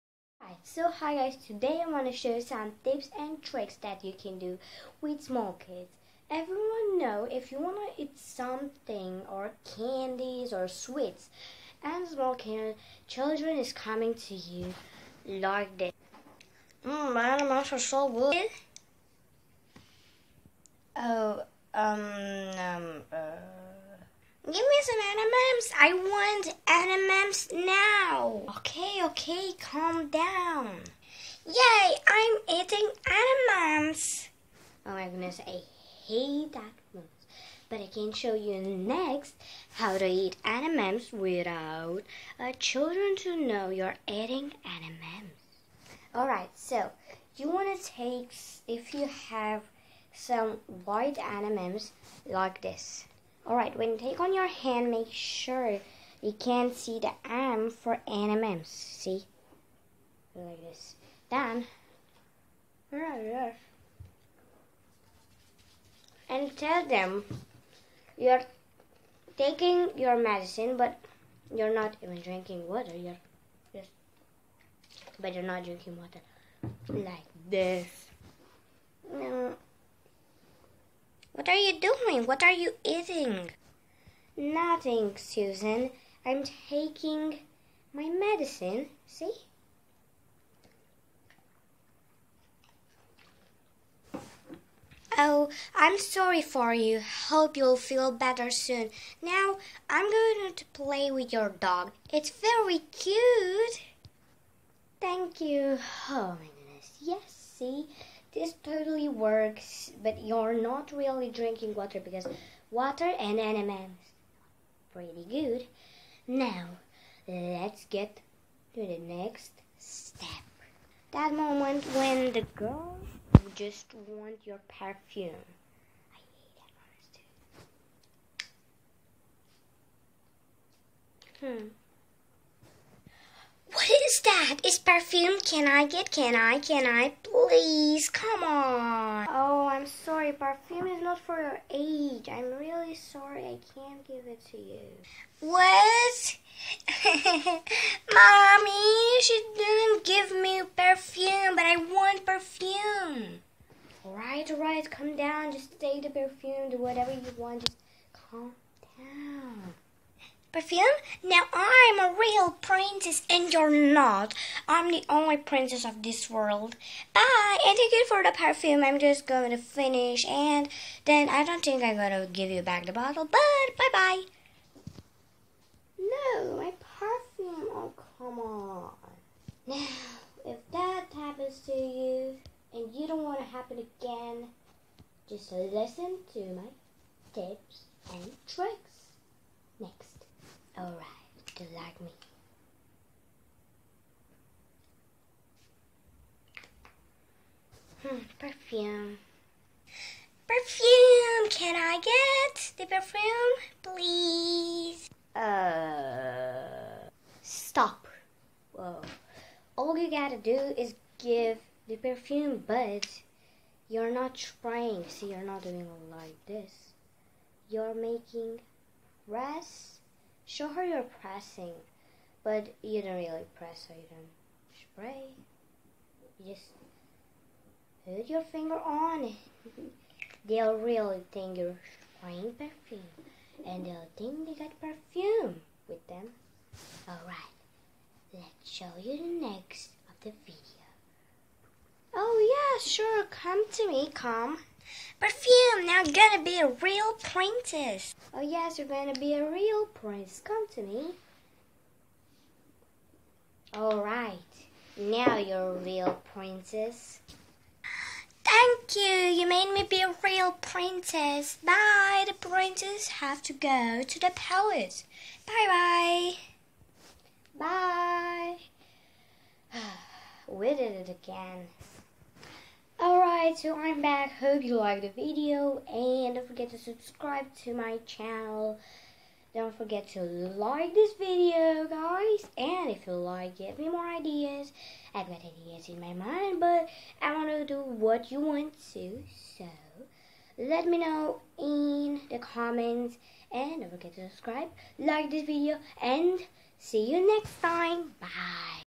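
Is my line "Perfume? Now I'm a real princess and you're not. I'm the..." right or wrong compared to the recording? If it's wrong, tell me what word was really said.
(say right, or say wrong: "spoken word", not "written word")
right.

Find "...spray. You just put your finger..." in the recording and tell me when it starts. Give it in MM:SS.
03:45.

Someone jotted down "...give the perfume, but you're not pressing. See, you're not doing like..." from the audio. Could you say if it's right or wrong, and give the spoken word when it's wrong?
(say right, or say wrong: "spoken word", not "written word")
wrong: "trying", not "pressing".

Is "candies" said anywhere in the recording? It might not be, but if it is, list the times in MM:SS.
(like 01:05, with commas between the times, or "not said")
00:09.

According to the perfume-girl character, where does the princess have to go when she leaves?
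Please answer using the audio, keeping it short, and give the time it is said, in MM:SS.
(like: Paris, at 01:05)
The palace, at 04:24.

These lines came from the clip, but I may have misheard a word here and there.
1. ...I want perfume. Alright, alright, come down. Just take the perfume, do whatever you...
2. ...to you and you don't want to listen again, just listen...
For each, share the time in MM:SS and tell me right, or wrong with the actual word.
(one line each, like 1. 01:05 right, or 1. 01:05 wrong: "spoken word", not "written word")
1. 02:31 right
2. 03:01 wrong: "happen", not "listen".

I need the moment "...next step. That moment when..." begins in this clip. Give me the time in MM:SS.
01:58.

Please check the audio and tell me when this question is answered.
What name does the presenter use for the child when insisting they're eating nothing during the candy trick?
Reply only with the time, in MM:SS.
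01:25.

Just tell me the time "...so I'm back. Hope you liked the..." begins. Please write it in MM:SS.
04:33.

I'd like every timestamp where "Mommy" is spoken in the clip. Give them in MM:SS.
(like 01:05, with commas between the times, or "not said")
02:28.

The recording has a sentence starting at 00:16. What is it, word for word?
Mmm, my animals are so good.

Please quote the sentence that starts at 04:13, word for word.
Alright, now you're a real princess.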